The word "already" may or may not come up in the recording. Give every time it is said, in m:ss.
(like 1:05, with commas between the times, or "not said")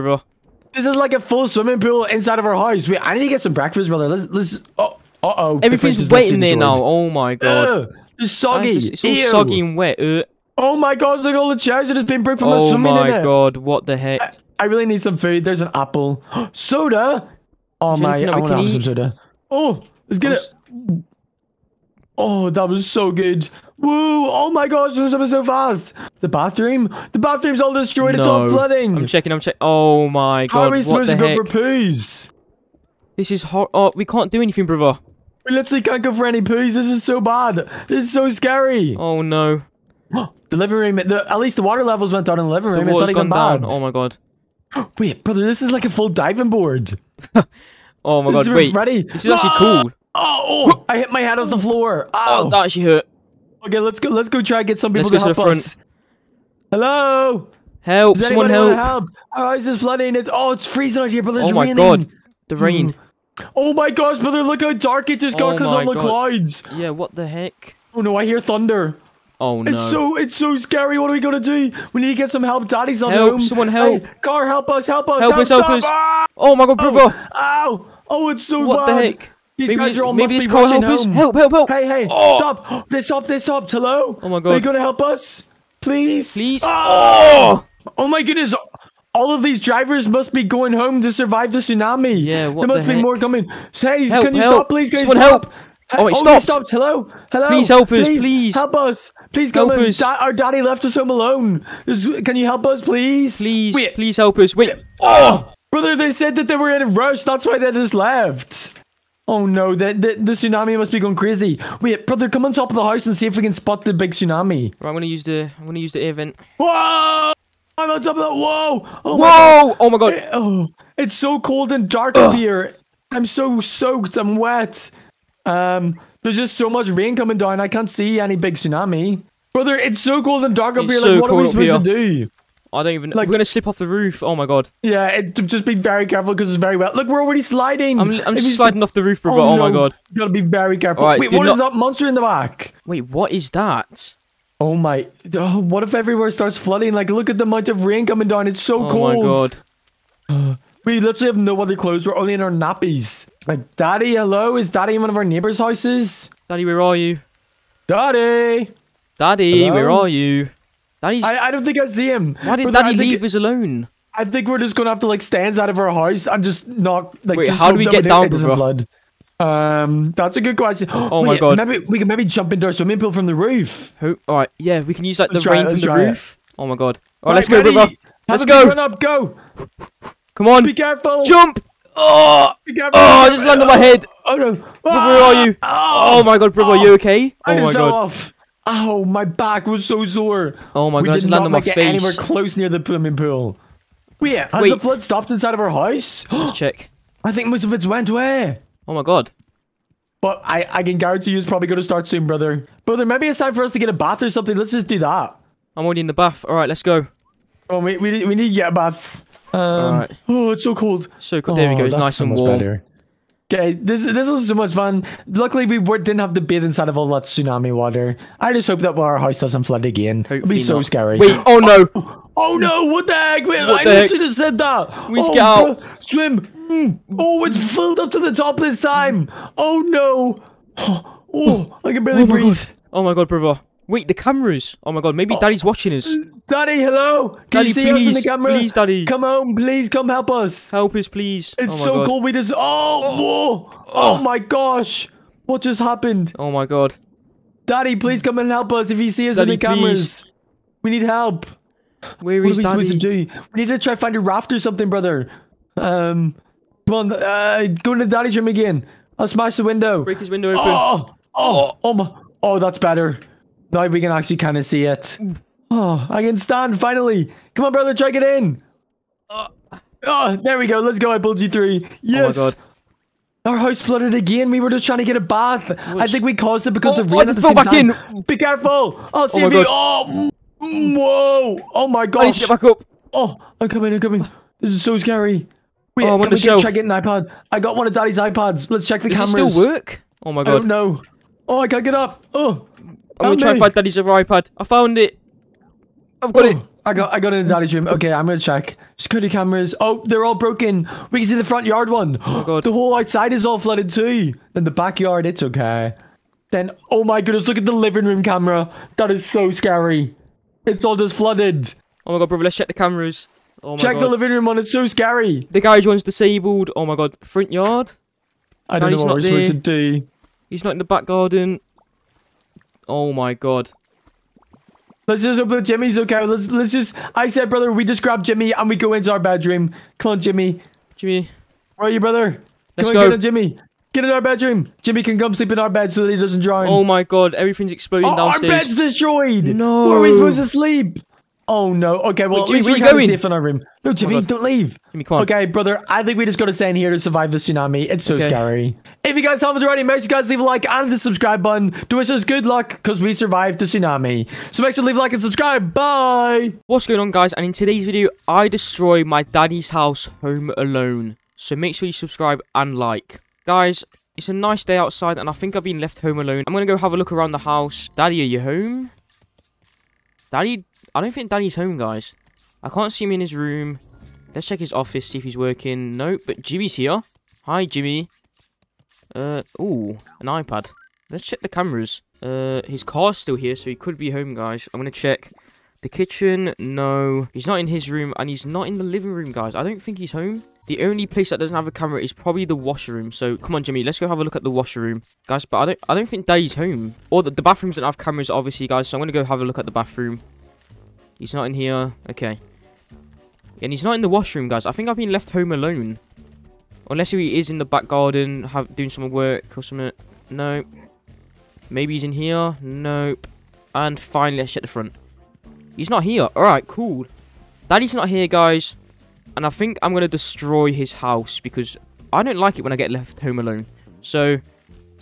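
2:17, 3:25, 5:49.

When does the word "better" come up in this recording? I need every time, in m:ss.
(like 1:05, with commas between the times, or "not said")
3:32, 4:22.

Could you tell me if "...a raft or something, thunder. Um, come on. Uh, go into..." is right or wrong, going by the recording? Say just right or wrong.
wrong.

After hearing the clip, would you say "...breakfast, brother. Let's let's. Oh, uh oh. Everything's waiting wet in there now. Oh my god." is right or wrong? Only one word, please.
right.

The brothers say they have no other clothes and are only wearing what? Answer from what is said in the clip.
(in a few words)
Nappies.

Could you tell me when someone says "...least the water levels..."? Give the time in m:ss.
0:41.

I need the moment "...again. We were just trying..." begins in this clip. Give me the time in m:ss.
4:34.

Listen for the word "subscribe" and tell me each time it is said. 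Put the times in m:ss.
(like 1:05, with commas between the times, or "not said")
5:50, 5:55, 6:01.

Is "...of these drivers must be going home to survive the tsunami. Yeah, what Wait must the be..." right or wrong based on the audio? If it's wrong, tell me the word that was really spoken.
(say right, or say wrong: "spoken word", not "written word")
wrong: "There", not "Wait".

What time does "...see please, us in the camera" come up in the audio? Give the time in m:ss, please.
3:57.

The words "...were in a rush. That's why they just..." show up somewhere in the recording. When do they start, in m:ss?
1:46.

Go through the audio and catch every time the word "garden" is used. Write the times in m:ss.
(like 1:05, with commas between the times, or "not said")
5:21, 6:47.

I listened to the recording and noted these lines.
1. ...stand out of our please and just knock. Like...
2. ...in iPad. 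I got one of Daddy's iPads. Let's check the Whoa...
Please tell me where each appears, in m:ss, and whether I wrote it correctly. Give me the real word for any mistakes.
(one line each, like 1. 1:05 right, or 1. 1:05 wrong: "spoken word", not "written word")
1. 2:45 wrong: "house", not "please"
2. 4:46 wrong: "Does", not "Whoa".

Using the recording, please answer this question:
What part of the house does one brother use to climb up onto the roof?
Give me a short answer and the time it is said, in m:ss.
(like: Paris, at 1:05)
The air vent, at 1:55.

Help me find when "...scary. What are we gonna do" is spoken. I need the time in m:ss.
1:10.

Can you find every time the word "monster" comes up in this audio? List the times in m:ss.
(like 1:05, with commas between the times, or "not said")
2:21.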